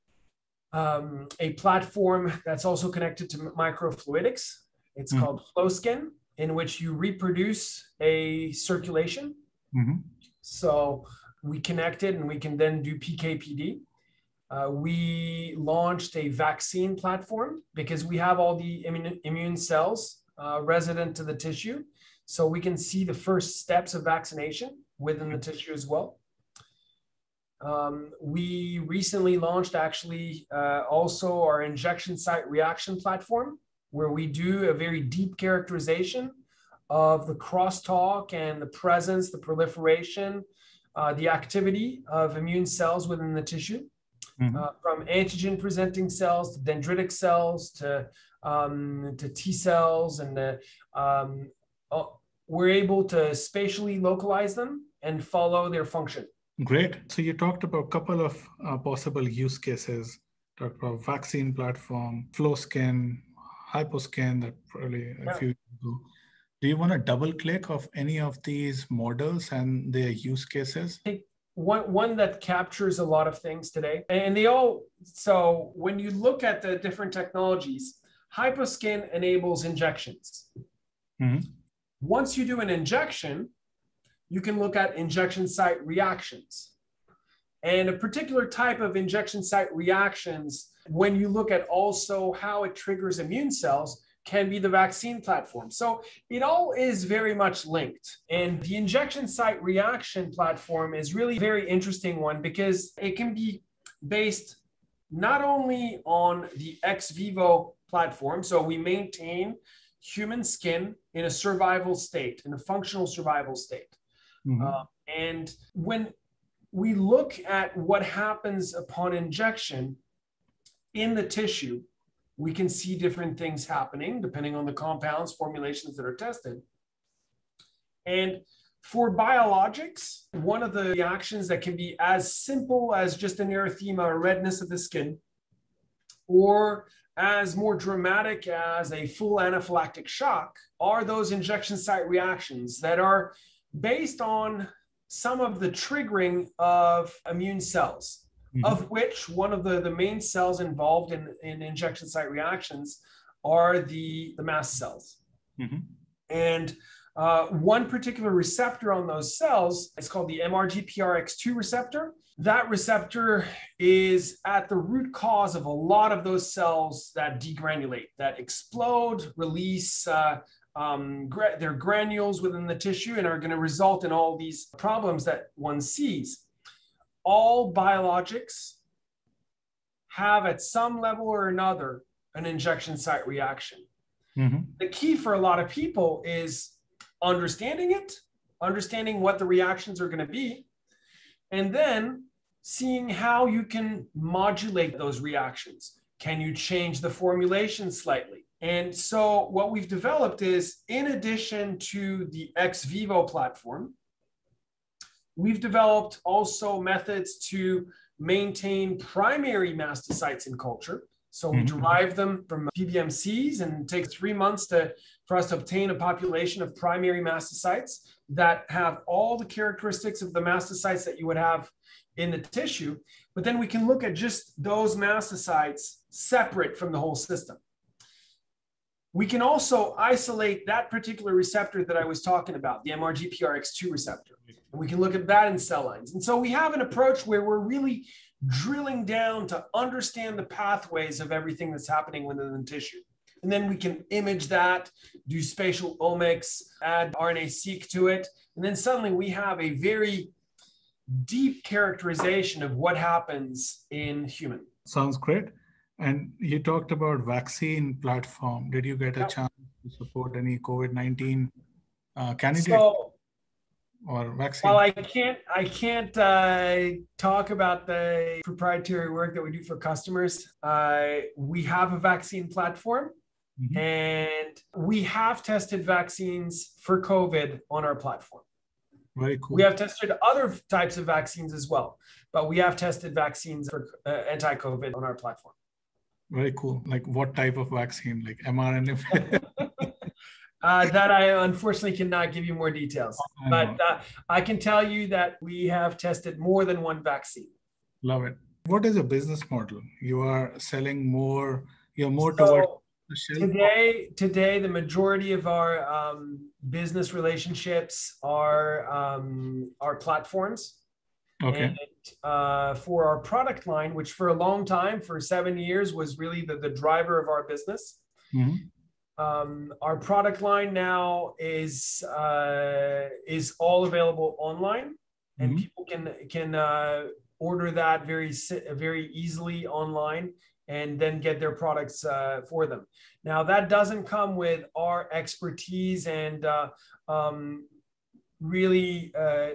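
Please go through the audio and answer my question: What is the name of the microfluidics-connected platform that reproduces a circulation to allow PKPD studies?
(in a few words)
FlowSkin.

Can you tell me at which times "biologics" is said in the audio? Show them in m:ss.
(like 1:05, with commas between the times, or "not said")
2:09, 2:57.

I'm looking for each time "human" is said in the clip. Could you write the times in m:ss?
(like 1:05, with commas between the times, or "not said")
1:50, 4:14.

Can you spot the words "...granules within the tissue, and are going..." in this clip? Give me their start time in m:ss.
2:51.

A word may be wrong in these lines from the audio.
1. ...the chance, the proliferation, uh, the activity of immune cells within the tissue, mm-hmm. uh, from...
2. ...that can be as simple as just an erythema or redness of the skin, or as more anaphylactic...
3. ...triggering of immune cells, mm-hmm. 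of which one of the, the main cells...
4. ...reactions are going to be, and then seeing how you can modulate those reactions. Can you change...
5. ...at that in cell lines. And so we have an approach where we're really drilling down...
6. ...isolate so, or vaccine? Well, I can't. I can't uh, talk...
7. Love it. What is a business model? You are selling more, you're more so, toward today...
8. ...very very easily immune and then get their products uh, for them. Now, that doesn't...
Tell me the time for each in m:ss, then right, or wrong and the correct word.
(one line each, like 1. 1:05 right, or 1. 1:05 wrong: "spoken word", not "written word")
1. 0:38 wrong: "presence", not "chance"
2. 2:11 wrong: "dramatic", not "anaphylactic"
3. 2:25 right
4. 3:09 right
5. 3:55 right
6. 4:22 wrong: "candidate", not "isolate"
7. 4:58 right
8. 5:28 wrong: "online", not "immune".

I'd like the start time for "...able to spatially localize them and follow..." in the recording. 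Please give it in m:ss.
0:52.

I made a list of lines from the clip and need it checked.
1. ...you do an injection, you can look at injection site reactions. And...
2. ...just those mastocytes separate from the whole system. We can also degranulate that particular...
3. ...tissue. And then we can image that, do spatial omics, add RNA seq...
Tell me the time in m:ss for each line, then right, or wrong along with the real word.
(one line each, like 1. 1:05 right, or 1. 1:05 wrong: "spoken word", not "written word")
1. 1:22 right
2. 3:44 wrong: "isolate", not "degranulate"
3. 4:02 right.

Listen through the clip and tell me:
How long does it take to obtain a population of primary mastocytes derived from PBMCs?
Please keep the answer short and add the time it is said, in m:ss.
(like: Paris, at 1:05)
3 months, at 3:34.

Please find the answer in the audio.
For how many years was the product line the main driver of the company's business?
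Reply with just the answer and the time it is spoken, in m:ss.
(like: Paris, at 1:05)
7 years, at 5:15.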